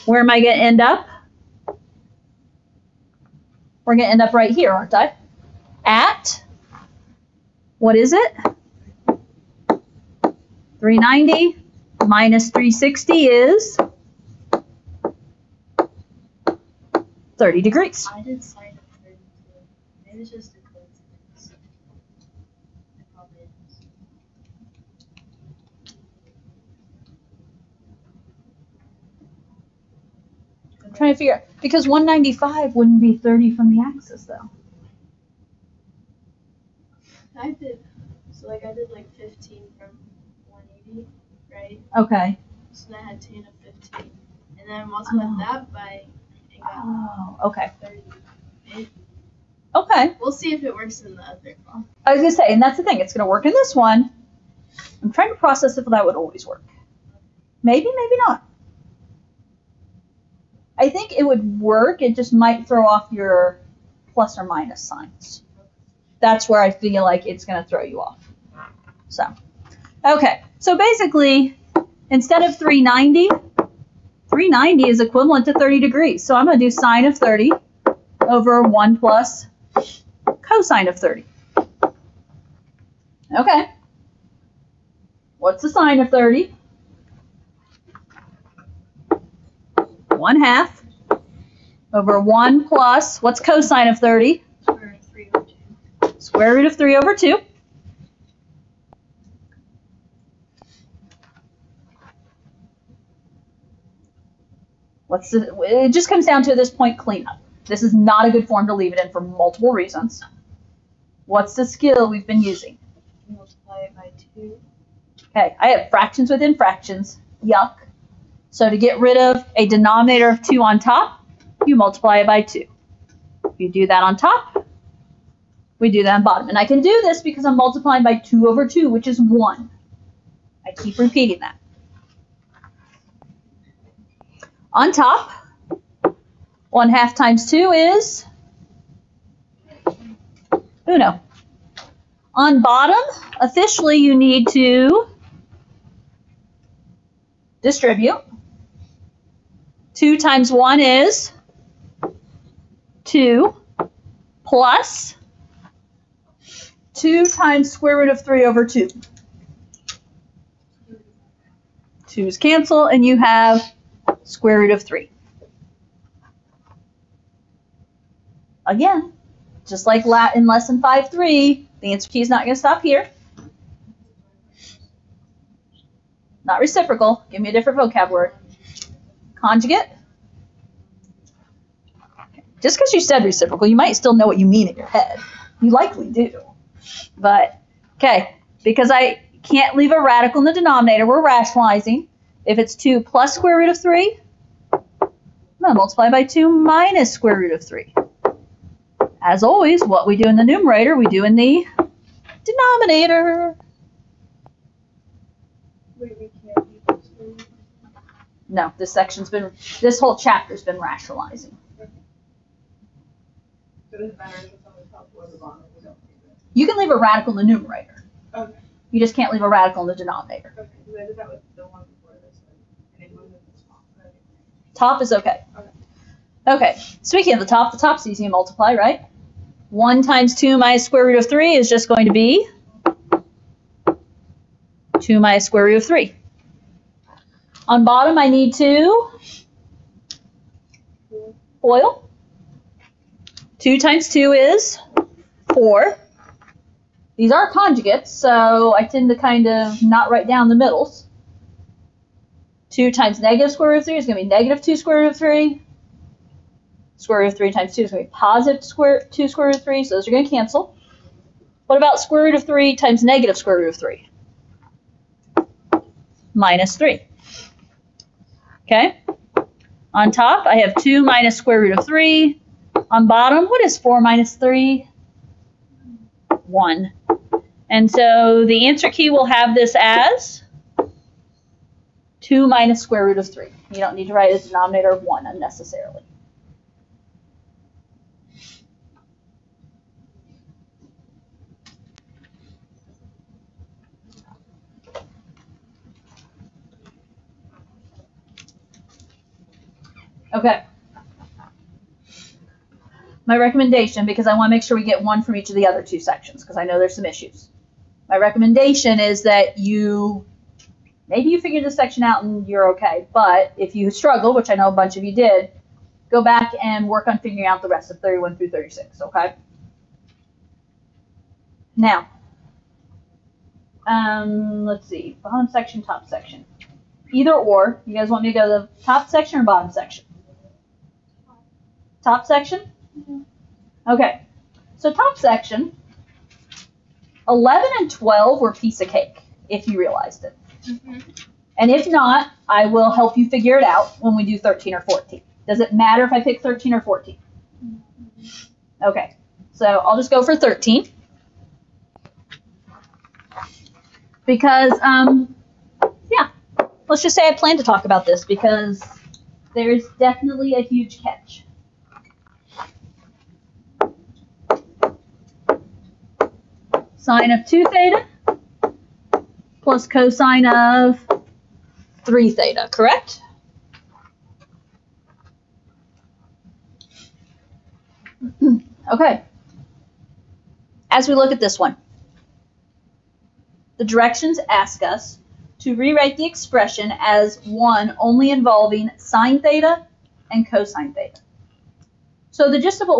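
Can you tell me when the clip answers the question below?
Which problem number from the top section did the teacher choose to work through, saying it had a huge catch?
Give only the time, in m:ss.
5:49.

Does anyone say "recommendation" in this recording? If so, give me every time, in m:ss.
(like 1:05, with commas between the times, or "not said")
5:03, 5:08.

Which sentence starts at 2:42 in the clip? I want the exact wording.
2's cancel, and you have square root of 3.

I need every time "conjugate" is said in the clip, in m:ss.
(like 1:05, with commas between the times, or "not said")
2:59, 4:07.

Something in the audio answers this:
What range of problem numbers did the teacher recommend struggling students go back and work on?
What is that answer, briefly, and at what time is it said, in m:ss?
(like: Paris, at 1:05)
31 through 36, at 5:17.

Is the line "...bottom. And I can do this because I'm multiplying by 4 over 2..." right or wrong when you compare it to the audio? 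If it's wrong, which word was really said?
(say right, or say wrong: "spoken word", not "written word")
wrong: "2", not "4".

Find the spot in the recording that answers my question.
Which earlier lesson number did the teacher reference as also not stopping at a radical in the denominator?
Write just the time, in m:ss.
2:50.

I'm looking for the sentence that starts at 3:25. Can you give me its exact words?
Wait, no, this section's been, this whole chapter's been rationalizing.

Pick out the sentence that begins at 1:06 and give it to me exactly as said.
That's where I feel like it's going to throw you off.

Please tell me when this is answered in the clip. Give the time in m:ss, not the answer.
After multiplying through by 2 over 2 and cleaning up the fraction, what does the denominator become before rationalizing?
3:12.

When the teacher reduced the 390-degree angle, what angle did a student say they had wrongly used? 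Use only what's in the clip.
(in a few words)
32.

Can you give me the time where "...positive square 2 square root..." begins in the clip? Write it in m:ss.
4:18.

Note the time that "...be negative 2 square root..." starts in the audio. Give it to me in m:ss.
4:14.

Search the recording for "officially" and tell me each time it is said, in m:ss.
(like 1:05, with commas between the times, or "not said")
2:23.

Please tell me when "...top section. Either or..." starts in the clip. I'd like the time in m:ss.
5:25.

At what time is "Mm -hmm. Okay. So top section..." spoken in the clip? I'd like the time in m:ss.
5:32.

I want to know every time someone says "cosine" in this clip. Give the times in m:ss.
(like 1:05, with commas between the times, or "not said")
1:20, 1:33, 6:09, 6:30.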